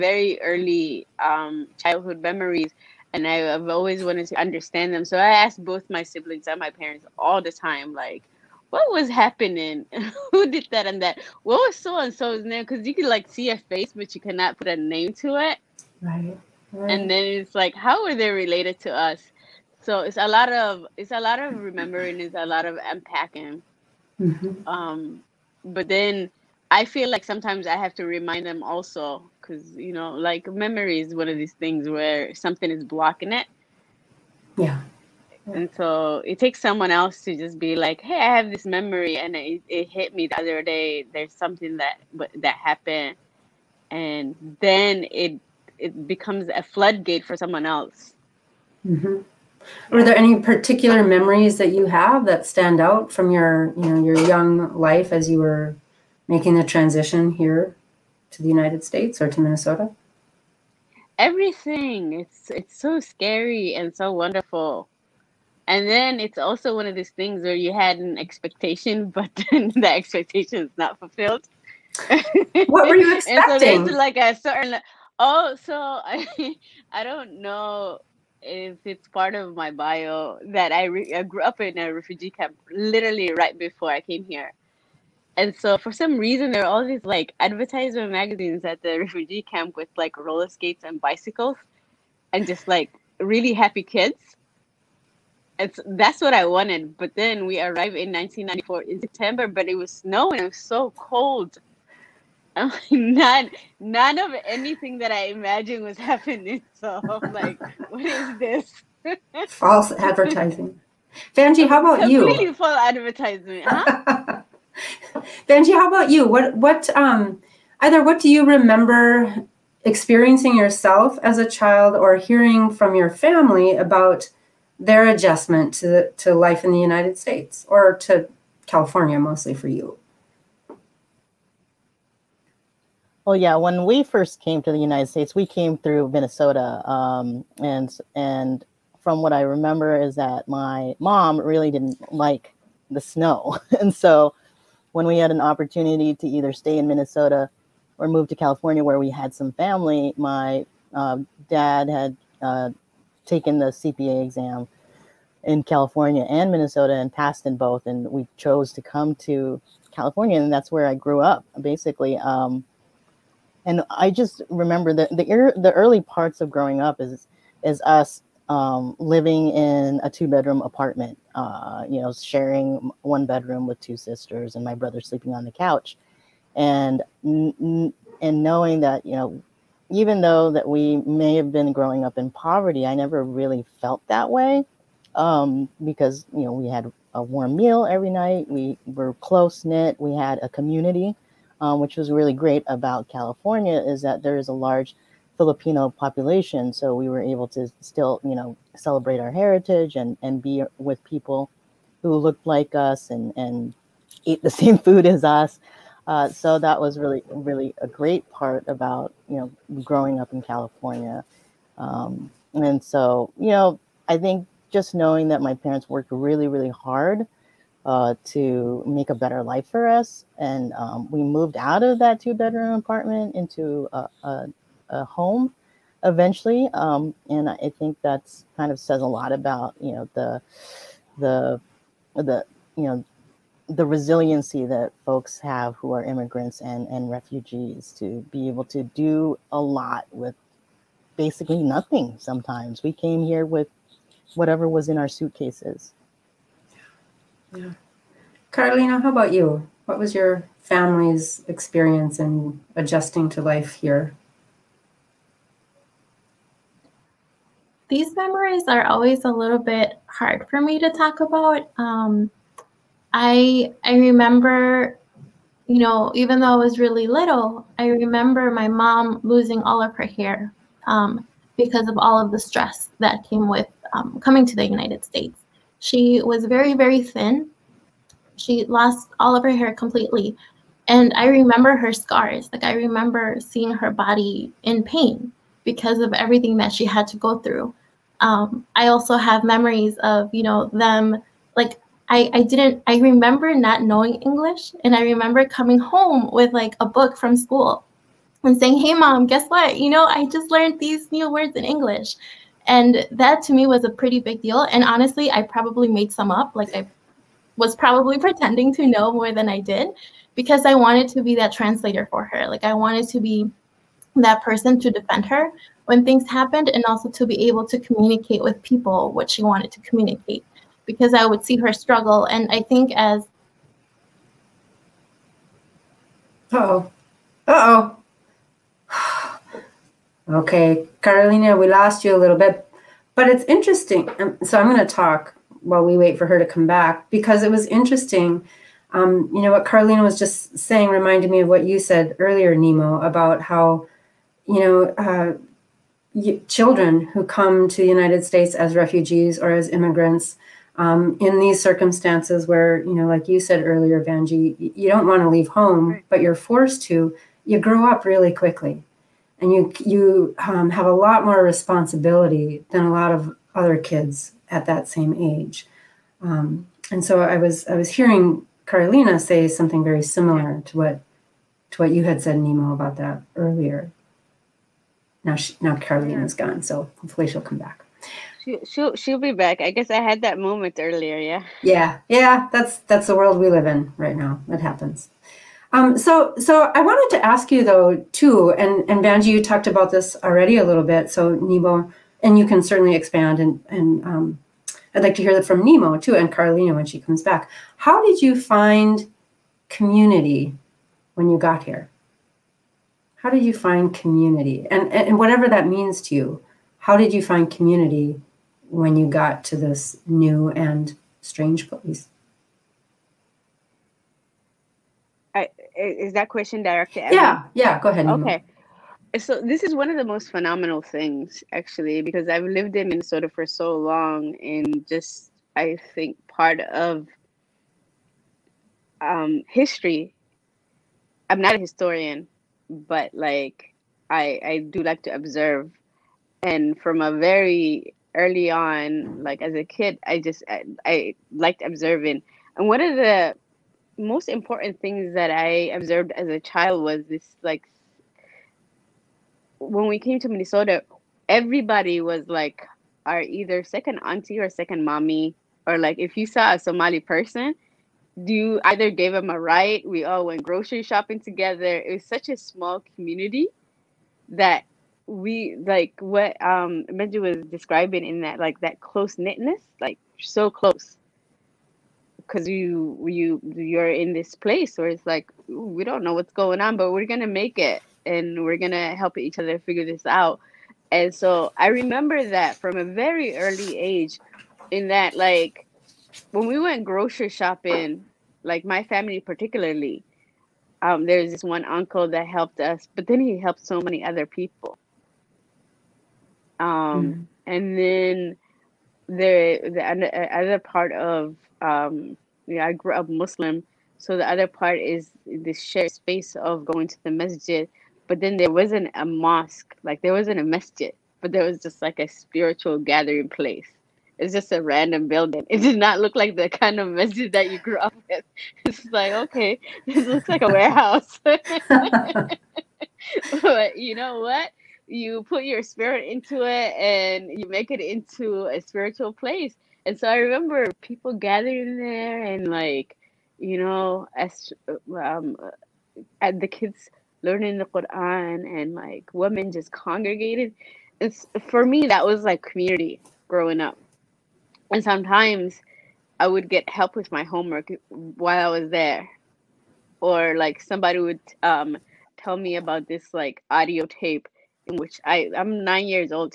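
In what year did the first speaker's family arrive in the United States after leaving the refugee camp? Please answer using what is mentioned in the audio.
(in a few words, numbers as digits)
1994.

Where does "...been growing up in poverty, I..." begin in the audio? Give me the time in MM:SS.
03:01.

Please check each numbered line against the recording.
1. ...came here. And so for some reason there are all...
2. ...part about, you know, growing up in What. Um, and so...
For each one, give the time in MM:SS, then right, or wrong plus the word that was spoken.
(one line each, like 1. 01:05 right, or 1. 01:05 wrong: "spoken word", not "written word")
1. 01:23 right
2. 03:28 wrong: "California", not "What".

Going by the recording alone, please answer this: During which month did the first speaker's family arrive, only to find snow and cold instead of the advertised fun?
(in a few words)
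September.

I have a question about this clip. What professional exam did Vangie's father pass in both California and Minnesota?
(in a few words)
CPA exam.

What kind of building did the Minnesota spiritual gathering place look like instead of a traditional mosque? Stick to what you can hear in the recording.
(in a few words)
a warehouse.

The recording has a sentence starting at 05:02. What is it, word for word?
And that to me was a pretty big deal.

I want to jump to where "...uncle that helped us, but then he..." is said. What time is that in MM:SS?
08:11.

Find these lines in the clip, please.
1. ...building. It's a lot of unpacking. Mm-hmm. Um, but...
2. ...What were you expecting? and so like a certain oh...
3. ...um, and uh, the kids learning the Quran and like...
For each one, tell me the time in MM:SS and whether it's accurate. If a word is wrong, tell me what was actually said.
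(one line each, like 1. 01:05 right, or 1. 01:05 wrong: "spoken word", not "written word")
1. 00:21 wrong: "remembering", not "building"
2. 01:12 right
3. 08:54 right.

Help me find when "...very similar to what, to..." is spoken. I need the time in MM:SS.
06:09.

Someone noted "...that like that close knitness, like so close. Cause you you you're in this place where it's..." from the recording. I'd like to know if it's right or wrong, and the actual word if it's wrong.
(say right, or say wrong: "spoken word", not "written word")
right.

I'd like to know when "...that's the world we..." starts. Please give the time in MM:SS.
06:22.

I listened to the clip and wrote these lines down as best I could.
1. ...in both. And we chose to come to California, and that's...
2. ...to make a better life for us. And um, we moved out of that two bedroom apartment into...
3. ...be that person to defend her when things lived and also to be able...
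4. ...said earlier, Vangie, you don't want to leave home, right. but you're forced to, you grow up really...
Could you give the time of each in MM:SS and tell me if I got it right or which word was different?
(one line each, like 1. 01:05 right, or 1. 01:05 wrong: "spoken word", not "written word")
1. 02:37 right
2. 03:38 right
3. 05:13 wrong: "happened", not "lived"
4. 05:53 right.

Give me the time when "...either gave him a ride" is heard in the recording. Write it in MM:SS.
07:38.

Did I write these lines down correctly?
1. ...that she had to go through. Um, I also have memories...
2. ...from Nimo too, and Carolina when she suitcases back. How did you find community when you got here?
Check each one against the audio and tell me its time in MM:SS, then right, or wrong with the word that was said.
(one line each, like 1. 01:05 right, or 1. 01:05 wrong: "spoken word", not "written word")
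1. 04:46 right
2. 06:35 wrong: "comes", not "suitcases".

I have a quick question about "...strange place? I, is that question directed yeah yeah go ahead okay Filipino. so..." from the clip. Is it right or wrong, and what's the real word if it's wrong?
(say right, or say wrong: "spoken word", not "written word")
wrong: "Nima", not "Filipino".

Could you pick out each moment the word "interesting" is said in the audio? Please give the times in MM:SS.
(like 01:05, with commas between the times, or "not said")
05:33, 05:37.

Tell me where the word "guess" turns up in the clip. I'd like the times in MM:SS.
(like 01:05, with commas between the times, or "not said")
04:59, 06:19.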